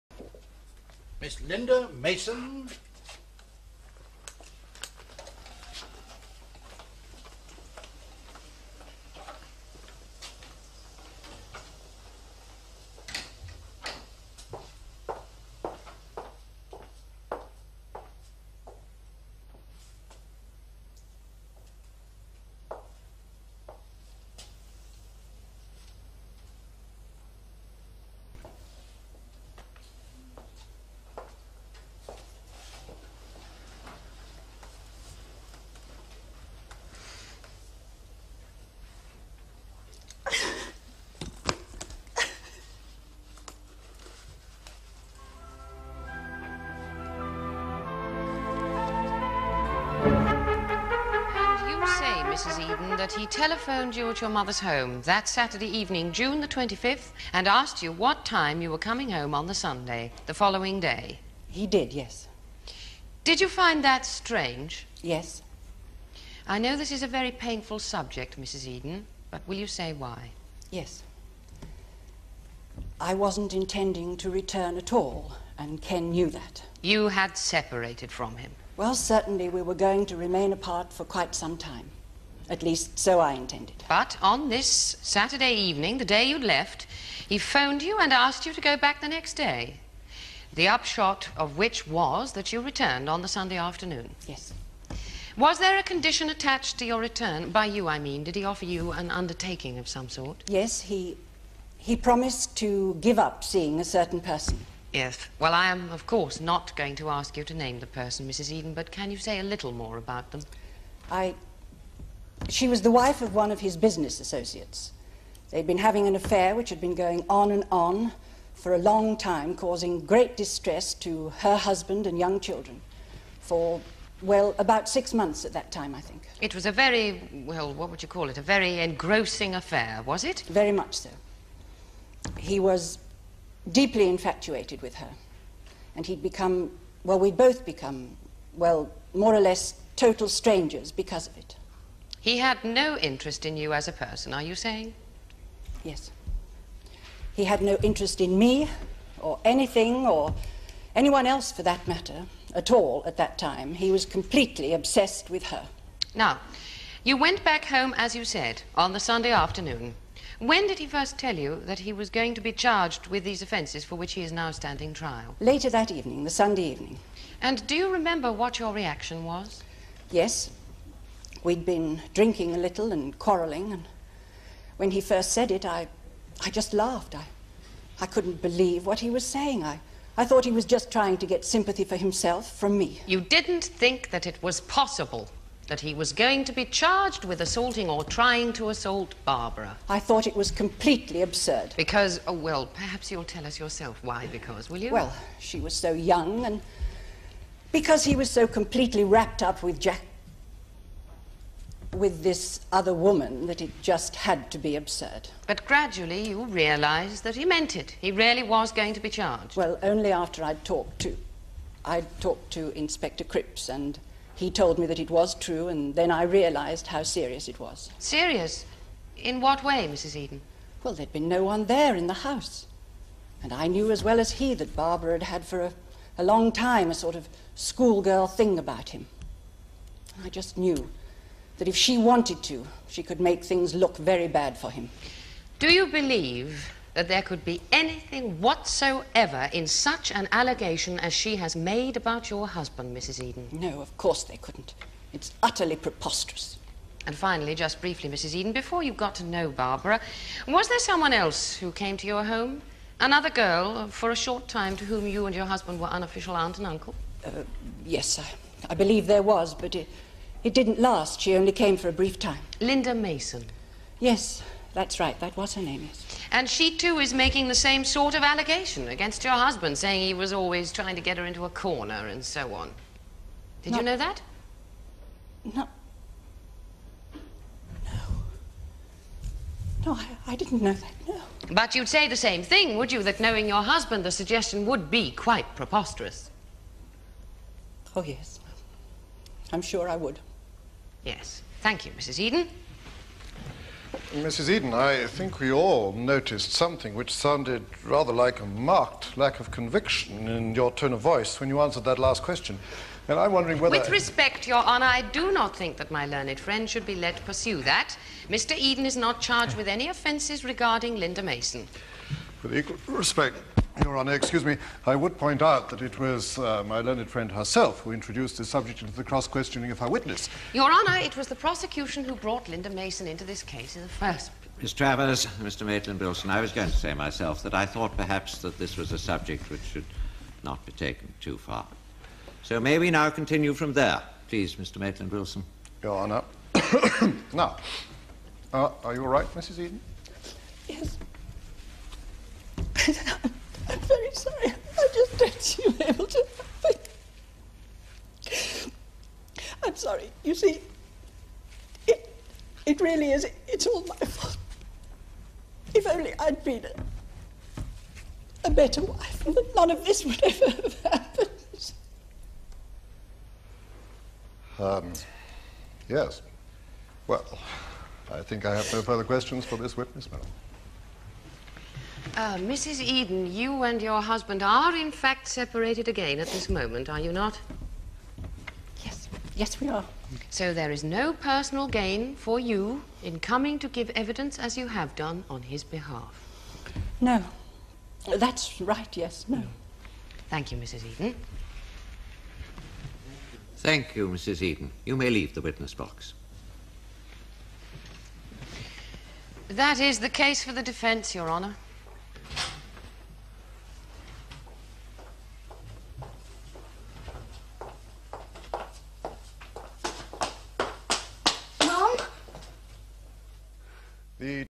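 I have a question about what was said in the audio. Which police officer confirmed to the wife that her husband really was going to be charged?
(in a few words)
Inspector Cripps.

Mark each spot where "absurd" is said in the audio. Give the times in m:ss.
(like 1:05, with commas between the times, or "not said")
3:11, 3:24.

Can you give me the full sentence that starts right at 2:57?
I, I couldn't believe what he was saying.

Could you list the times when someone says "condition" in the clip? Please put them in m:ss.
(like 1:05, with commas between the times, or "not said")
1:35.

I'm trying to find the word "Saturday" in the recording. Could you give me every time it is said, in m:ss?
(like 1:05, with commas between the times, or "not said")
0:55, 1:25.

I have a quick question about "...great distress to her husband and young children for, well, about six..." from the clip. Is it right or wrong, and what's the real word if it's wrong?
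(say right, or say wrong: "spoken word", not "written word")
right.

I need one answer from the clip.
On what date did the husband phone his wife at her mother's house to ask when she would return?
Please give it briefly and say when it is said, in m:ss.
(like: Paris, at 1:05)
June 25th, at 0:56.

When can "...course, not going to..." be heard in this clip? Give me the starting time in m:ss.
1:46.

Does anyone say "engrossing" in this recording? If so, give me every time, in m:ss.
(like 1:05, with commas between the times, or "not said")
2:08.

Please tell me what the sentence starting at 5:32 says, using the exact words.
So may we now continue from there?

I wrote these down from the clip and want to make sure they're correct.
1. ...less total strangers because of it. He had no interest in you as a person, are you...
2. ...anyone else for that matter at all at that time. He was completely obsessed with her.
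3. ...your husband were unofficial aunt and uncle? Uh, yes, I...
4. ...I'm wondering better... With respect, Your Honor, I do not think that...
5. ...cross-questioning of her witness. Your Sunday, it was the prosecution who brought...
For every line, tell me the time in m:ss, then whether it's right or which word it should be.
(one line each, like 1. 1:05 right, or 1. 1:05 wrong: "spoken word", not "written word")
1. 2:19 right
2. 2:30 right
3. 4:15 right
4. 5:03 wrong: "whether", not "better"
5. 5:19 wrong: "Honour", not "Sunday".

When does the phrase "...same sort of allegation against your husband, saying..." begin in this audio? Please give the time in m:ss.
4:27.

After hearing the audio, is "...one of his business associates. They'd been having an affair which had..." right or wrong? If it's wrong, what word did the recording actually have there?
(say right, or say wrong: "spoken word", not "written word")
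right.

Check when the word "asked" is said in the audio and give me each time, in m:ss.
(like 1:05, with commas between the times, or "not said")
0:57, 1:28.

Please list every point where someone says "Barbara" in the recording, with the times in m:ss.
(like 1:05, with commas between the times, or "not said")
3:09, 3:44, 4:09.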